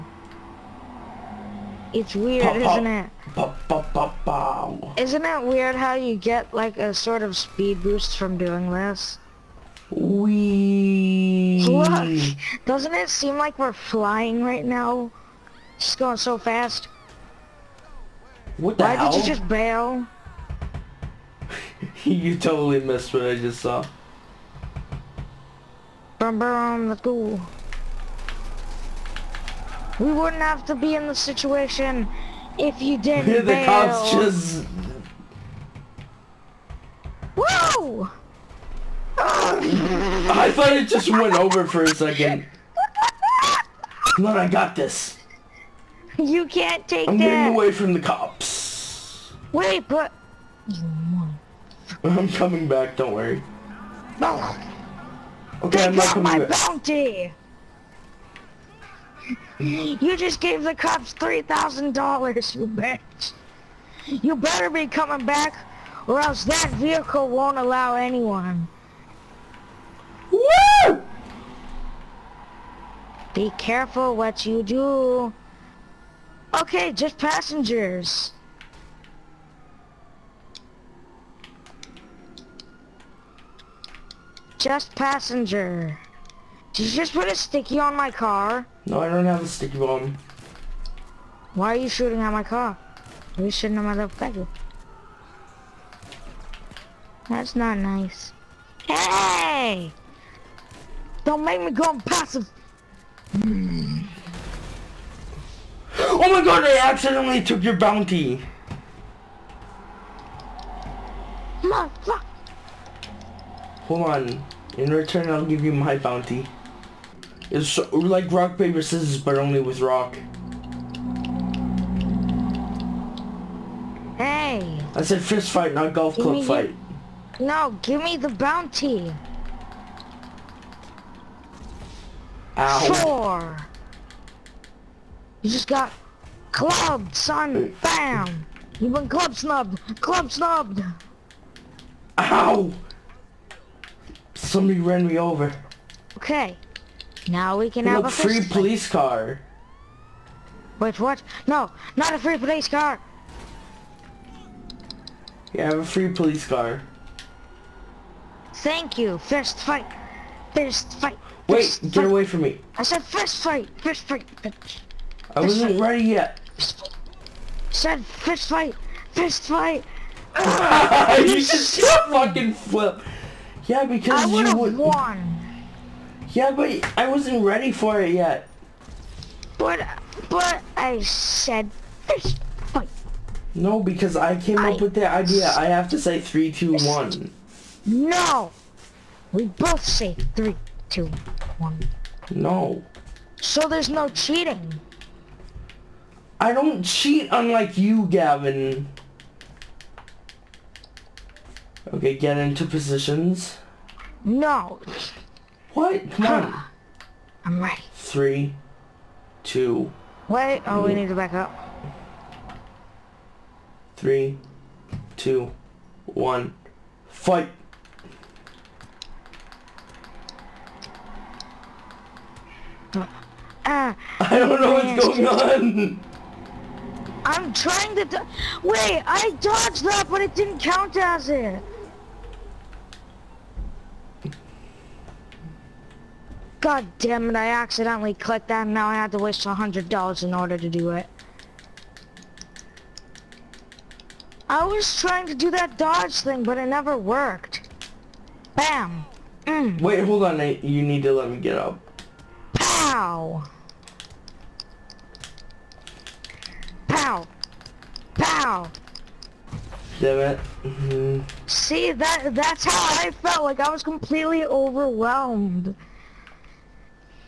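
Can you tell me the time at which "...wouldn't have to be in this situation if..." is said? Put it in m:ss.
0:30.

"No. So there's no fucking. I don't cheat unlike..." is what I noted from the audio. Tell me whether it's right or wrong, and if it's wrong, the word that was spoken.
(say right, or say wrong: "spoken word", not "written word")
wrong: "cheating", not "fucking".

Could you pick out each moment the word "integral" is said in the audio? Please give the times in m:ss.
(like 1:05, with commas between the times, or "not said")
not said.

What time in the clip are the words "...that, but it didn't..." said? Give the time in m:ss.
3:49.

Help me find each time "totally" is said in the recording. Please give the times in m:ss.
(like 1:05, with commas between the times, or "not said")
0:22.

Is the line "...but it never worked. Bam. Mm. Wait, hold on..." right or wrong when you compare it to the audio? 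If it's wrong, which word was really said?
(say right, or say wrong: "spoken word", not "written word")
right.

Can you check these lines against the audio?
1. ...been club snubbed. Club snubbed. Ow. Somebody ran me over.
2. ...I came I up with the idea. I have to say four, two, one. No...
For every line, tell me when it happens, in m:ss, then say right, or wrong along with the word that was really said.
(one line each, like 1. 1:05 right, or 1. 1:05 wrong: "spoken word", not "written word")
1. 2:18 right
2. 3:04 wrong: "three", not "four".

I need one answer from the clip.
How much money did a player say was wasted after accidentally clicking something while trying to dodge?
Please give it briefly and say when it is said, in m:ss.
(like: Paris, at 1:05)
$100, at 3:59.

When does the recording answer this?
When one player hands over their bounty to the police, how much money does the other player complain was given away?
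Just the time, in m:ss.
1:01.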